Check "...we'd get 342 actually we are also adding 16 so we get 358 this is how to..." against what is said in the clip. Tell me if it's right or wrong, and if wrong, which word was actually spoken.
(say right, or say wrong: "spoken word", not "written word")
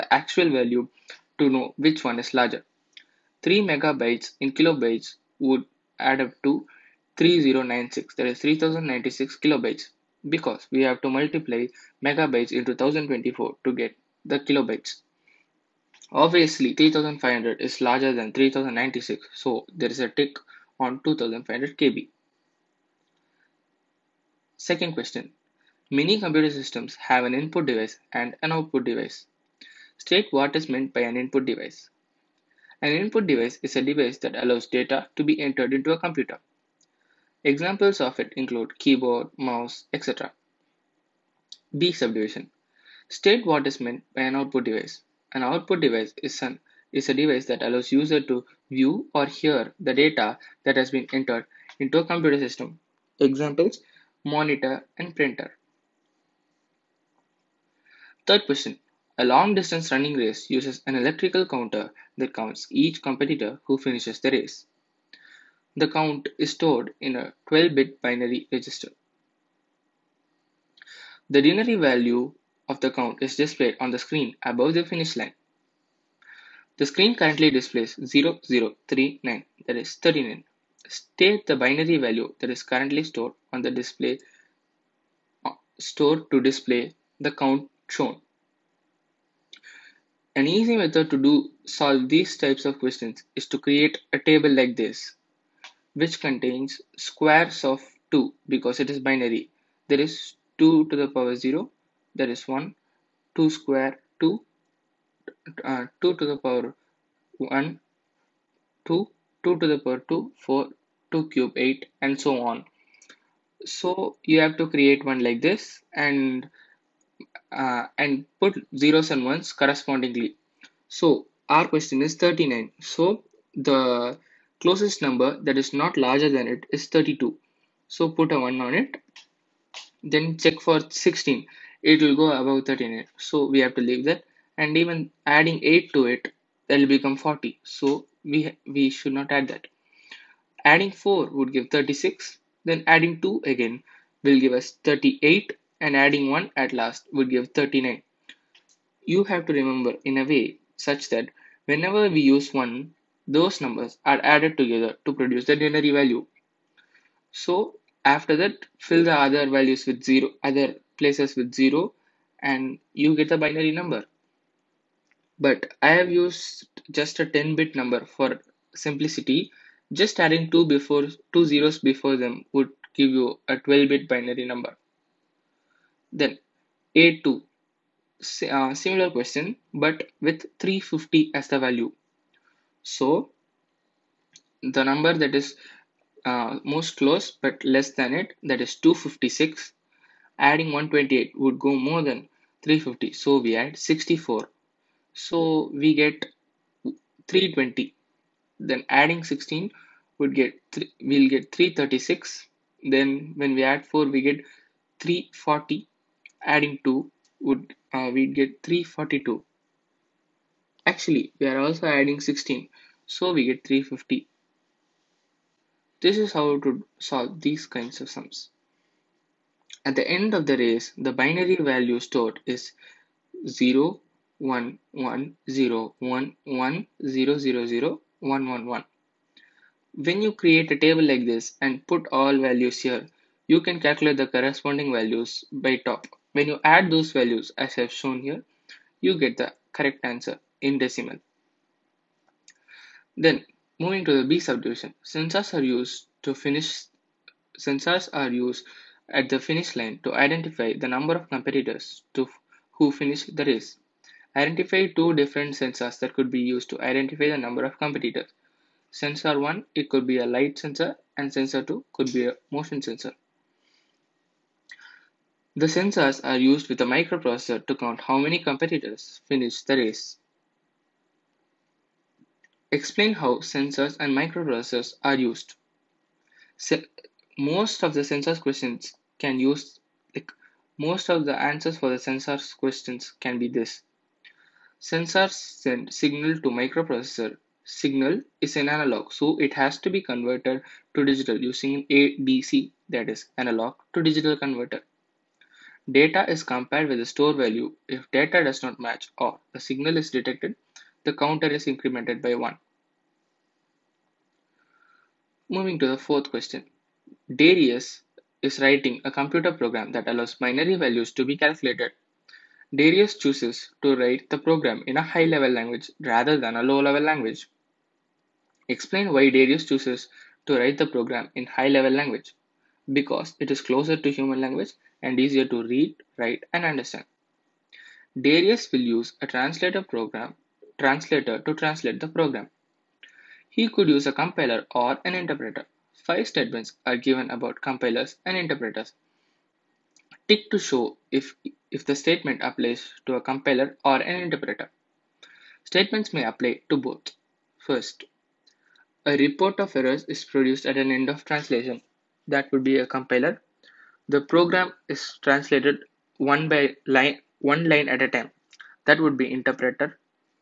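wrong: "350", not "358".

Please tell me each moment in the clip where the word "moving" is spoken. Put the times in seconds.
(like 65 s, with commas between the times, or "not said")
243 s, 305 s.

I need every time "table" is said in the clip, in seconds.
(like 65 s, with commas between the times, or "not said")
94 s, 230 s.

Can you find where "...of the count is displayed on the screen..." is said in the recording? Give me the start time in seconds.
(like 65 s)
72 s.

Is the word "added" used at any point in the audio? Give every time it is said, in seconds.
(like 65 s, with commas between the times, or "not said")
154 s.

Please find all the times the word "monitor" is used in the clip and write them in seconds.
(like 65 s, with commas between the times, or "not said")
54 s.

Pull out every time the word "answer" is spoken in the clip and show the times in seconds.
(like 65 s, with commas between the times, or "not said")
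240 s, 281 s.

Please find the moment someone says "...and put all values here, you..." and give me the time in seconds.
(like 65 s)
231 s.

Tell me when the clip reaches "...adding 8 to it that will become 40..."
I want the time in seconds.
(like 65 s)
135 s.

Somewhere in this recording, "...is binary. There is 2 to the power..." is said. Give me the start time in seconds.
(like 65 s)
98 s.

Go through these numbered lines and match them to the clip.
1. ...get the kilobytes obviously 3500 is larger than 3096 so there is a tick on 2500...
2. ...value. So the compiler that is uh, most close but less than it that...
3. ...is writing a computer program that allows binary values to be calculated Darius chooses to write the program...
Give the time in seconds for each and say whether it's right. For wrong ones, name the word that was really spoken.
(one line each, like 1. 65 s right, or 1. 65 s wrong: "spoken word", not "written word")
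1. 13 s right
2. 181 s wrong: "number", not "compiler"
3. 308 s right.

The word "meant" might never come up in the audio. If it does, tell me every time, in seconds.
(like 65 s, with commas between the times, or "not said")
30 s, 43 s.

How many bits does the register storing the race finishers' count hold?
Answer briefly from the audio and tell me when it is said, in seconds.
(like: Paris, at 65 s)
12, at 67 s.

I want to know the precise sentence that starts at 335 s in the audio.
Five statements are given about compilers and interpreters.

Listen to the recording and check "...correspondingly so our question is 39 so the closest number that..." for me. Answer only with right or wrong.
right.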